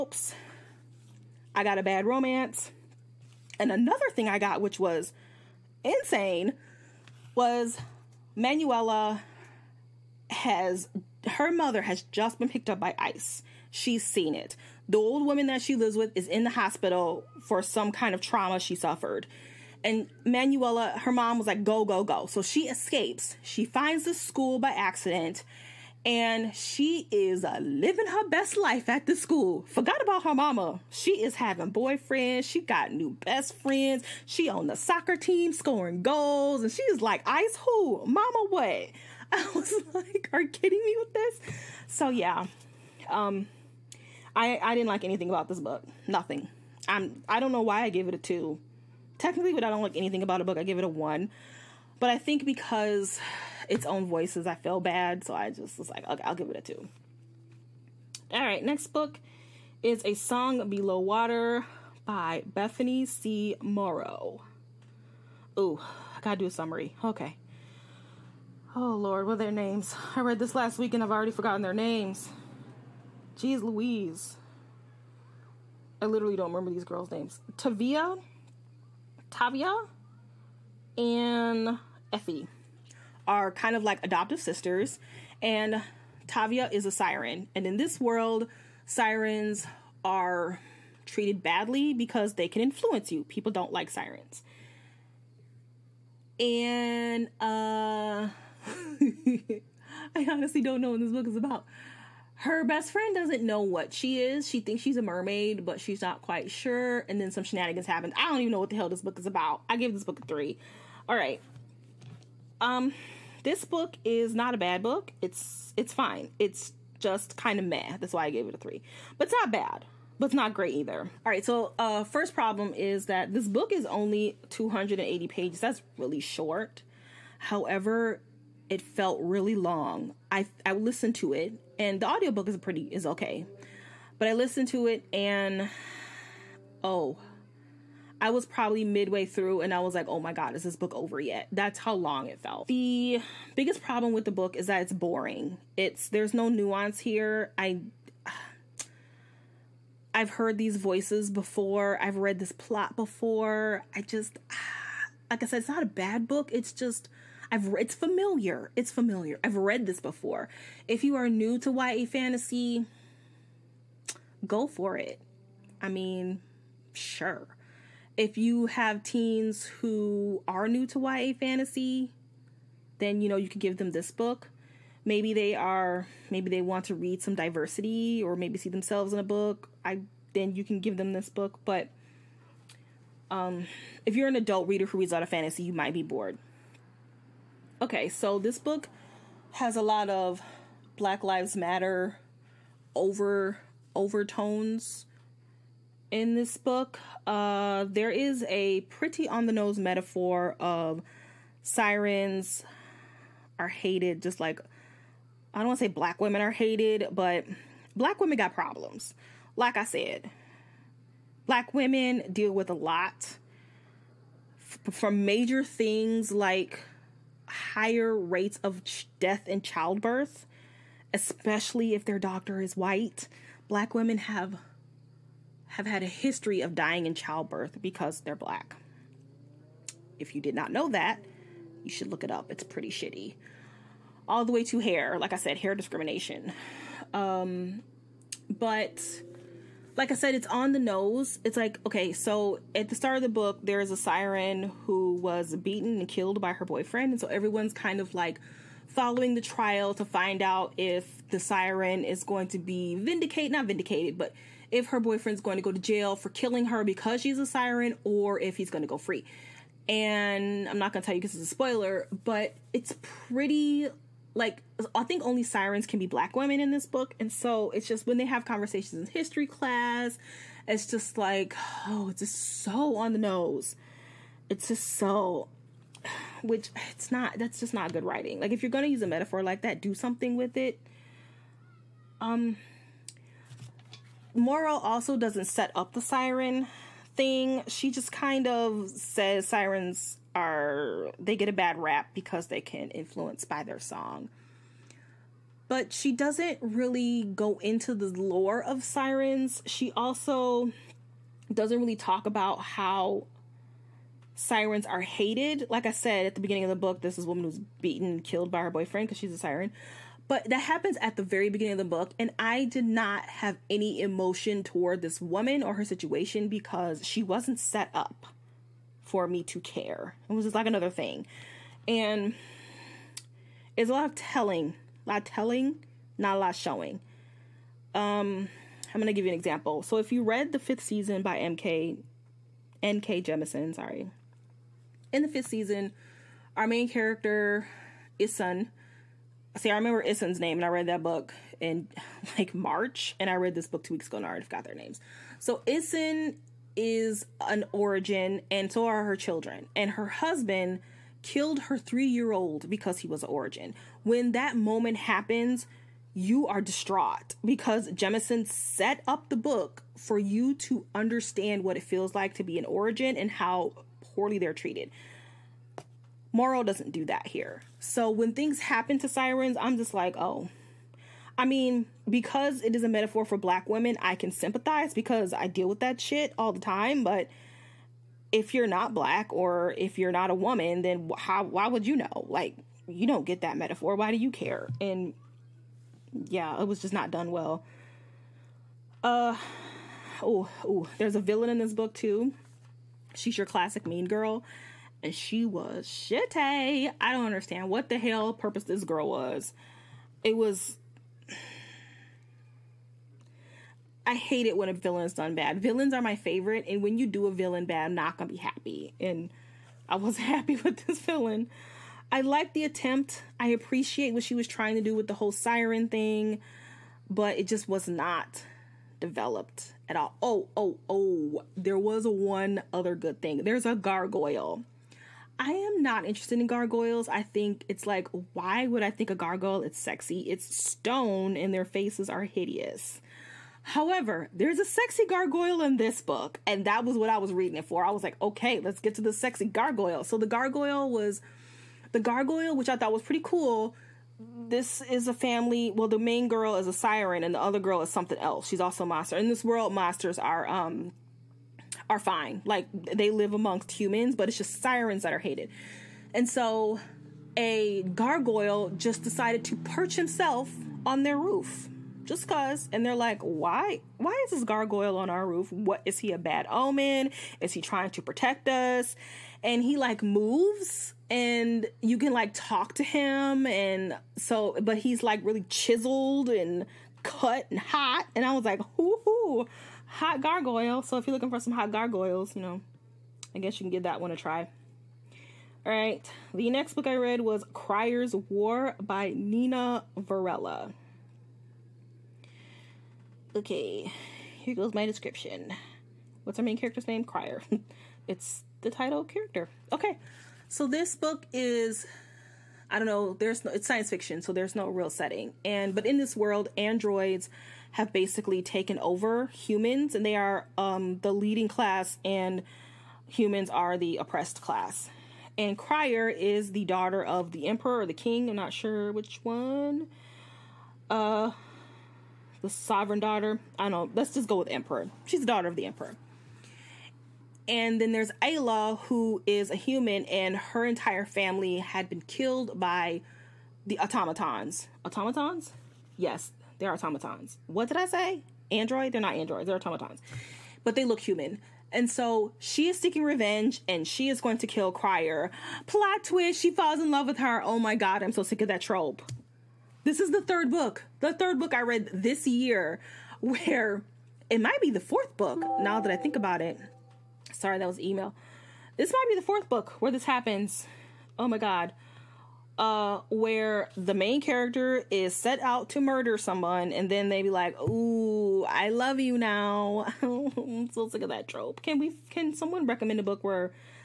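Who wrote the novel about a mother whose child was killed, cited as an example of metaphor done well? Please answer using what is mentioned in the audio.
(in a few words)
N.K. Jemisin.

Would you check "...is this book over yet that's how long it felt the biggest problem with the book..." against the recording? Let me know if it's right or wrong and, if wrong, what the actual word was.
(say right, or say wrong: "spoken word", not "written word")
right.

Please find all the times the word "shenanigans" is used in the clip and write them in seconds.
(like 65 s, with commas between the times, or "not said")
107 s.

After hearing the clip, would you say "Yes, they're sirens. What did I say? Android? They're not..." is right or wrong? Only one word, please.
wrong.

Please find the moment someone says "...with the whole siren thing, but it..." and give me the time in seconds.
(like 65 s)
414 s.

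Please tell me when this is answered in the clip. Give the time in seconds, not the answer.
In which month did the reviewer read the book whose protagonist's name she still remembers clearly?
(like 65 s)
342 s.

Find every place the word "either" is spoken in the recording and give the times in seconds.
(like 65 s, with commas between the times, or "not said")
120 s.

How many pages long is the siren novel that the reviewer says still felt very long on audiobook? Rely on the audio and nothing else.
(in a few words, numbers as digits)
280.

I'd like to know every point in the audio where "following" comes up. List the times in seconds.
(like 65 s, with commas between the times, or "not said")
248 s.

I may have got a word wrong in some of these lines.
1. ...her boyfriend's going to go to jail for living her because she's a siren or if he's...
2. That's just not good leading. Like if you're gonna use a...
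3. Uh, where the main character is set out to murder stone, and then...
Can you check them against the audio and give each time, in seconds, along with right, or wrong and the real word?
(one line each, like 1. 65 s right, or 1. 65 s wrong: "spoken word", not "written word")
1. 254 s wrong: "killing", not "living"
2. 277 s wrong: "writing", not "leading"
3. 562 s wrong: "someone", not "stone".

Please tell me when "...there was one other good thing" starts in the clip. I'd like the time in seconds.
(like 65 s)
421 s.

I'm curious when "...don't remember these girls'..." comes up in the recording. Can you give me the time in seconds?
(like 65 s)
76 s.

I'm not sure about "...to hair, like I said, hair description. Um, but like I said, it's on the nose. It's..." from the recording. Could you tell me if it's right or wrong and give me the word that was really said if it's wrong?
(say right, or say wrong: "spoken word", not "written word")
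wrong: "discrimination", not "description".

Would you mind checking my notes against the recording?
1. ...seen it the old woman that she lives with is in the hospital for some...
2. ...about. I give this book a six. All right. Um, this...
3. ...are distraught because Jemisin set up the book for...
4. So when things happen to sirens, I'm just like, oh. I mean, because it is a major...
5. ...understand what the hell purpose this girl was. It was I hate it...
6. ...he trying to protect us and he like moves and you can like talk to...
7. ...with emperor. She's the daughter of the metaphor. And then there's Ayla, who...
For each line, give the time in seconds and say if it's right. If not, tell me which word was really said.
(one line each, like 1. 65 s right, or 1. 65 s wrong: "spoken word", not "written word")
1. 14 s right
2. 109 s wrong: "three", not "six"
3. 356 s right
4. 367 s wrong: "metaphor", not "major"
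5. 397 s right
6. 467 s right
7. 524 s wrong: "emperor", not "metaphor".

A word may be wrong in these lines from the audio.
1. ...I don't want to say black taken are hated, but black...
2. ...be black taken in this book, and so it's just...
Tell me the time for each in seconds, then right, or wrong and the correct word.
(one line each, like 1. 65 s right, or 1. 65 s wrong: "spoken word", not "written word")
1. 205 s wrong: "women", not "taken"
2. 265 s wrong: "women", not "taken".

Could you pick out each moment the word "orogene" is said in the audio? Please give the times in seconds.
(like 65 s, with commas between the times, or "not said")
347 s, 353 s, 362 s.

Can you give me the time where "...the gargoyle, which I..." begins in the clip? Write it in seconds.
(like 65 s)
441 s.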